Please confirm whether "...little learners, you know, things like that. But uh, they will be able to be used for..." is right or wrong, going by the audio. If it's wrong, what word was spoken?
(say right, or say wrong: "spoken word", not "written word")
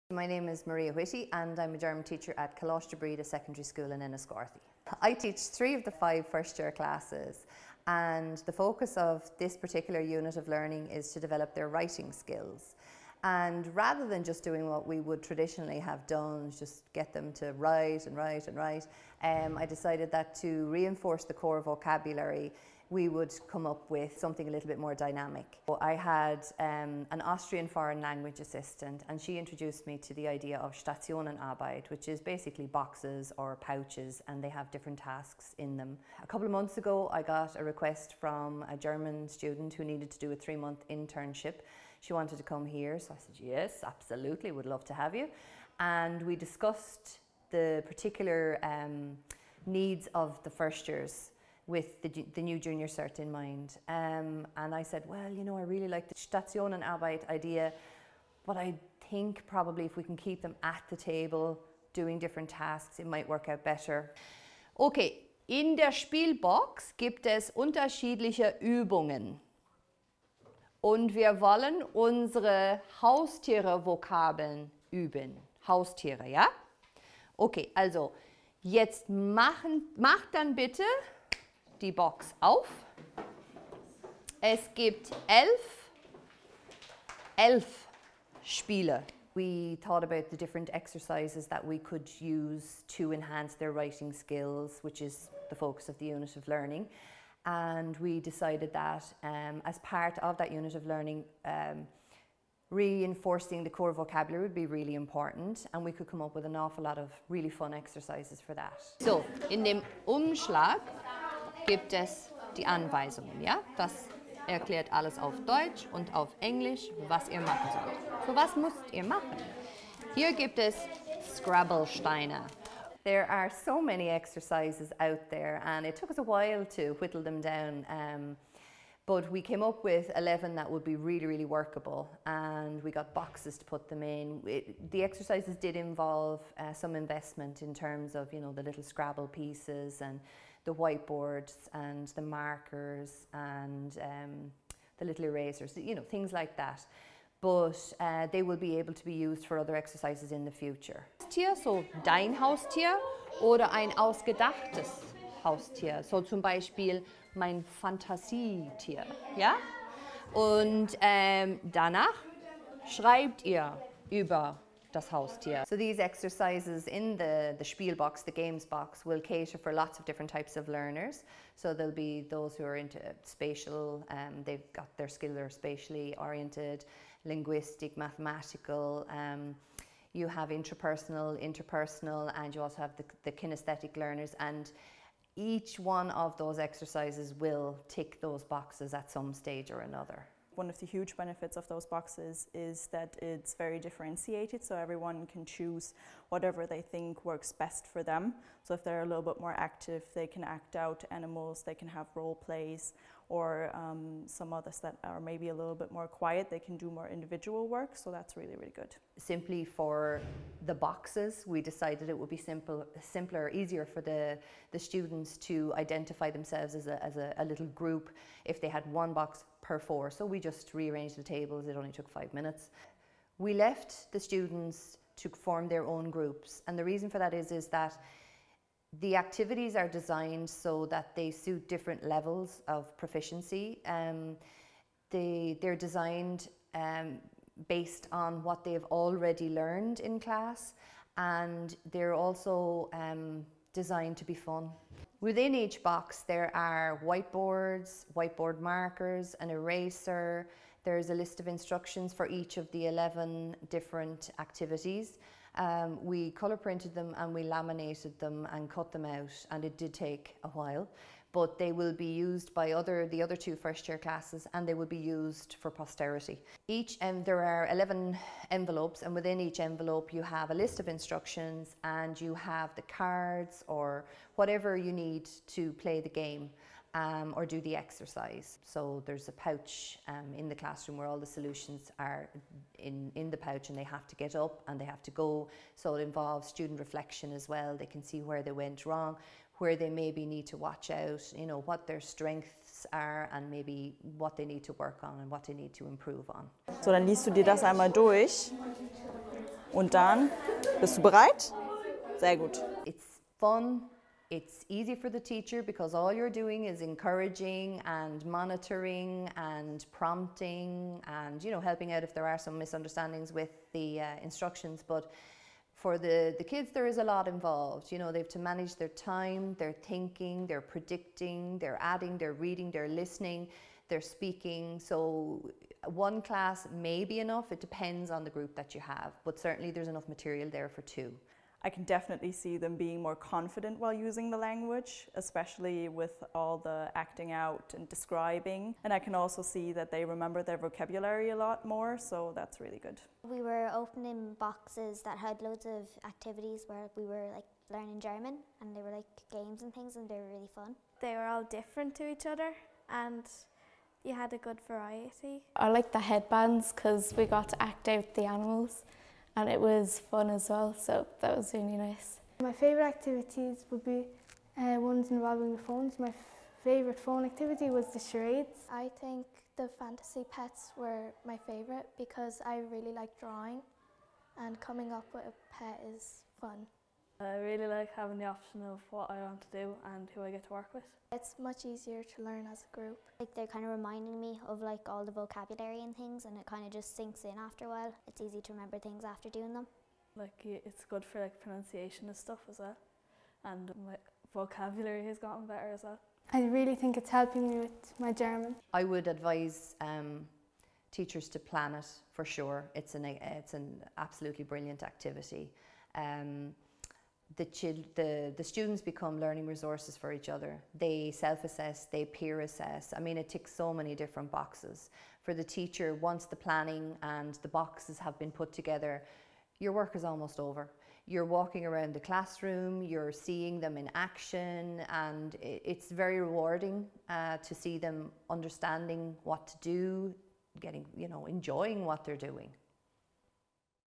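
wrong: "erasers", not "learners".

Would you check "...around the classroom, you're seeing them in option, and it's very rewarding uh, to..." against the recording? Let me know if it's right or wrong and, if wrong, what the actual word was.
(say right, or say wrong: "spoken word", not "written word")
wrong: "action", not "option".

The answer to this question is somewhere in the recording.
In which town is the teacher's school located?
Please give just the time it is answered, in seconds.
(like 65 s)
4 s.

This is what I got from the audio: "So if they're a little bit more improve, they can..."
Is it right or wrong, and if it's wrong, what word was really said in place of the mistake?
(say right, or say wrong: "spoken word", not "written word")
wrong: "active", not "improve".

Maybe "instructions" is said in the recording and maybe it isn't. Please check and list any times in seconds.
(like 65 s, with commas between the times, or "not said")
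251 s, 270 s, 314 s.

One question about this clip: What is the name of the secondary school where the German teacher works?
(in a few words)
Coláiste Bride.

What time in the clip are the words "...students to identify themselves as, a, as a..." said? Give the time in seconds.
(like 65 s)
214 s.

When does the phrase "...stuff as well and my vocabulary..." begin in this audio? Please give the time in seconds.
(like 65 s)
392 s.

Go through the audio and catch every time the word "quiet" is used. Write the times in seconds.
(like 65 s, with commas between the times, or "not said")
206 s.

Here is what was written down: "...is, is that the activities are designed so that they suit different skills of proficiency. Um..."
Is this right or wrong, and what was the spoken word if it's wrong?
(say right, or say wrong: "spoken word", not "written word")
wrong: "levels", not "skills".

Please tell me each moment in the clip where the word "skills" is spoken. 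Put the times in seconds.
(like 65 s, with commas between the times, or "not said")
12 s, 94 s, 175 s.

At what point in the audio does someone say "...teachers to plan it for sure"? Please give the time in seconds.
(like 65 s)
400 s.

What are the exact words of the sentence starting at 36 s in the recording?
A couple of months ago, I got a request from a German student who needed to do a three month internship.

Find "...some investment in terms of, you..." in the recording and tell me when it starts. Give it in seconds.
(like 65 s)
136 s.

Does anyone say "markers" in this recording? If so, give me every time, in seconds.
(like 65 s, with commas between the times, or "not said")
142 s, 248 s.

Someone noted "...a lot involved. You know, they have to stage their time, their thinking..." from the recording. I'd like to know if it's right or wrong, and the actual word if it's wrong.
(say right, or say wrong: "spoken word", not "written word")
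wrong: "manage", not "stage".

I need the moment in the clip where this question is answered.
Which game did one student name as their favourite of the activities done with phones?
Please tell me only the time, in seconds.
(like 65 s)
367 s.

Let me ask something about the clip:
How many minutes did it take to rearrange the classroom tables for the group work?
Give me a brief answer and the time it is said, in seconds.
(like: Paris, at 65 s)
5, at 222 s.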